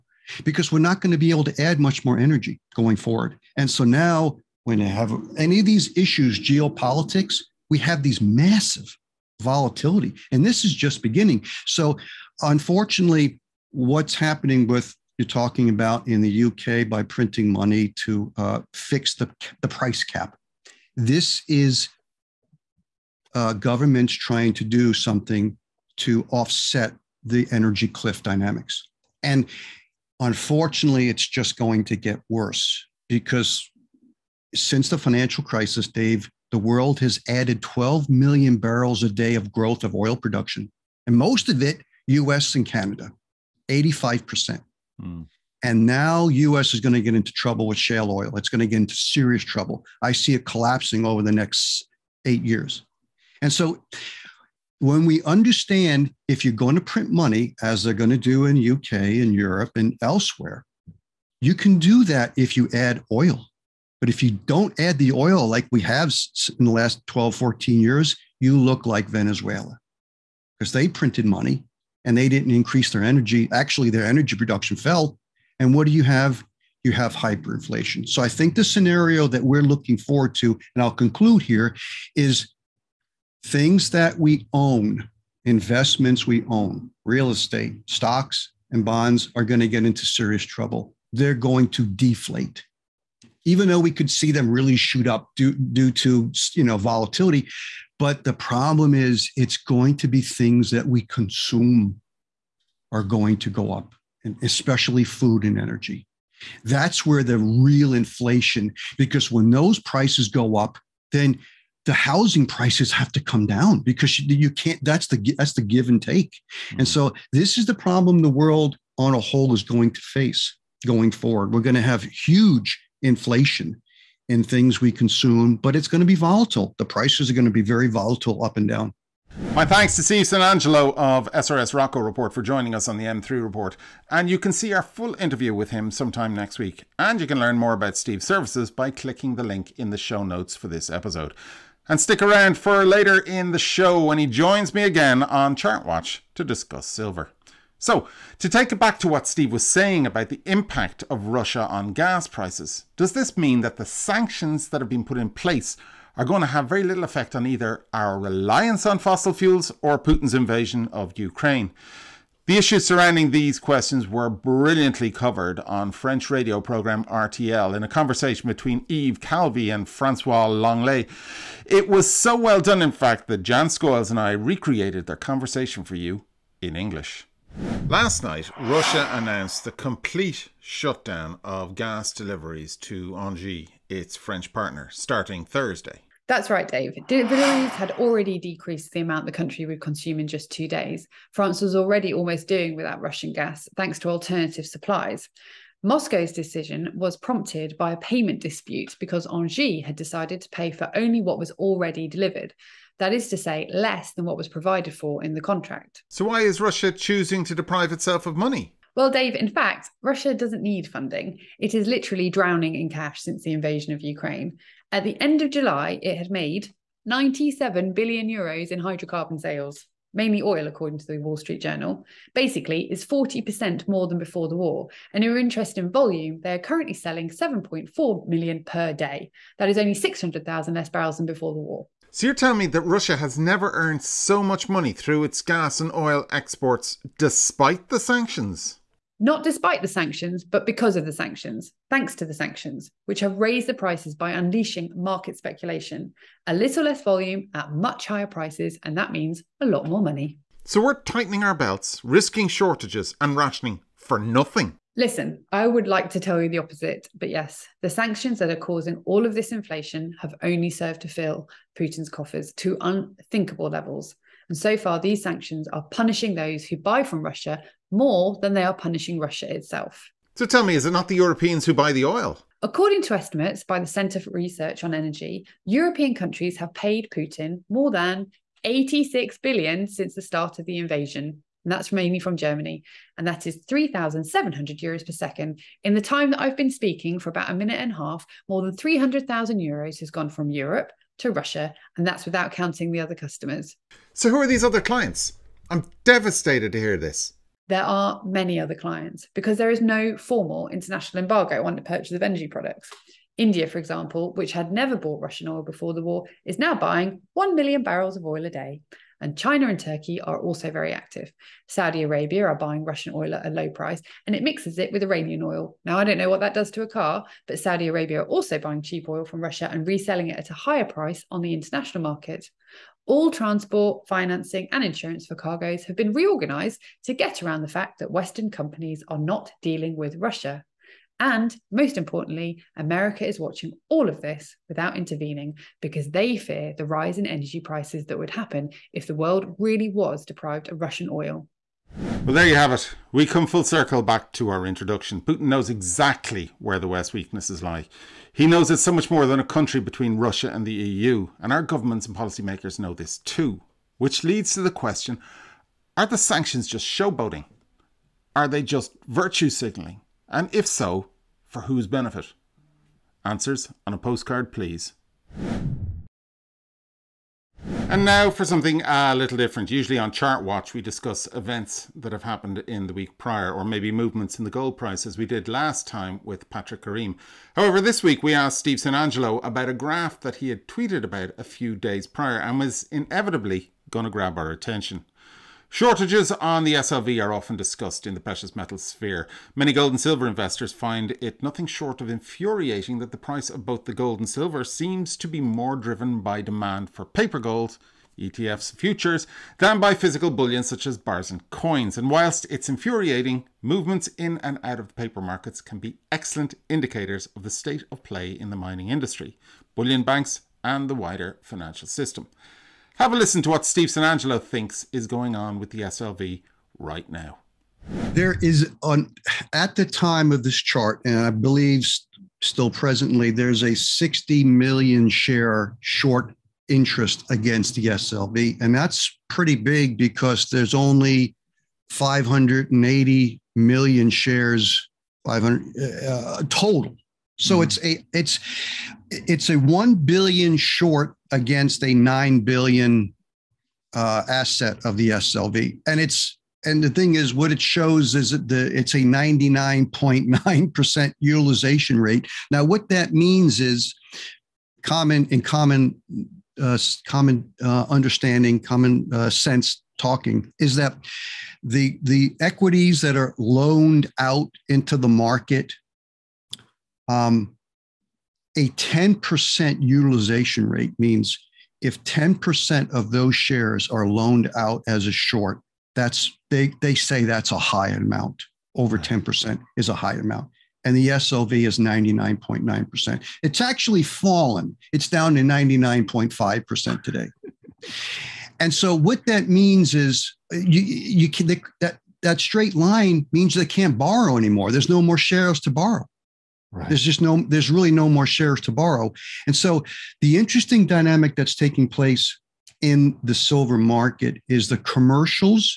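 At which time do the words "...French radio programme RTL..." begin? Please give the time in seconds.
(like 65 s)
165 s.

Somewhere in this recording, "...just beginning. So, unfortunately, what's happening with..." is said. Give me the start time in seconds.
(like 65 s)
10 s.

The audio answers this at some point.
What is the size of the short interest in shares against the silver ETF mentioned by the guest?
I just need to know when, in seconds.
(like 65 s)
423 s.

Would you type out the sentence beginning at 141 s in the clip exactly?
And stick around for later in the show when he joins me again on Chartwatch to discuss silver.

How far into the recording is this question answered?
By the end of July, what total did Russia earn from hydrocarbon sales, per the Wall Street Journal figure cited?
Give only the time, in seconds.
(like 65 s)
217 s.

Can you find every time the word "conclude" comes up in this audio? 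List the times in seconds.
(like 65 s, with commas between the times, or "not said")
80 s.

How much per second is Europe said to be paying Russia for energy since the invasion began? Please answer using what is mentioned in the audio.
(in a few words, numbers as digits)
3,700 euros.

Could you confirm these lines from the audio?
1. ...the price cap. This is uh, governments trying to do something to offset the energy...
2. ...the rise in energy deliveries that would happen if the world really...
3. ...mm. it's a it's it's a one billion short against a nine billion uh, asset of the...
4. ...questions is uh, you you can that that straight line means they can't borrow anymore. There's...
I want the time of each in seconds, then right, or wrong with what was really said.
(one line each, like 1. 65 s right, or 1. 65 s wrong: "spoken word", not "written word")
1. 19 s right
2. 336 s wrong: "prices", not "deliveries"
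3. 437 s right
4. 489 s wrong: "means", not "questions".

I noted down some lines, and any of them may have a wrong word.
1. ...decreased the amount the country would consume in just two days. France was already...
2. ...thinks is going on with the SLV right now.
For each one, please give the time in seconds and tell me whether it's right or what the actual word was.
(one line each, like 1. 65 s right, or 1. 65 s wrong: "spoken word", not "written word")
1. 188 s right
2. 414 s right.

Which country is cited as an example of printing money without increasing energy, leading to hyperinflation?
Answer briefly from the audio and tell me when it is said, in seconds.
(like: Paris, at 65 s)
Venezuela, at 69 s.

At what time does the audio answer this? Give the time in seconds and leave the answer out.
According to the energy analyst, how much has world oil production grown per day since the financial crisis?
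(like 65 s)
37 s.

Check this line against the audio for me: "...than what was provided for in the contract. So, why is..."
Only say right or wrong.
right.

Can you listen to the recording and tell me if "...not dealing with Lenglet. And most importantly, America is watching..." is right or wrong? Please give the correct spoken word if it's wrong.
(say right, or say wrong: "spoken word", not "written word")
wrong: "Russia", not "Lenglet".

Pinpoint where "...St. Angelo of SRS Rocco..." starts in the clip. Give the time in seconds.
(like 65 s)
130 s.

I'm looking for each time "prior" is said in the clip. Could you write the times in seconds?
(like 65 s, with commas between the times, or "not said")
373 s, 382 s.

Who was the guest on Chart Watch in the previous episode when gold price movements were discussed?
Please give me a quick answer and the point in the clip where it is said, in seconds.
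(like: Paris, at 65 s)
Patrick Karim, at 376 s.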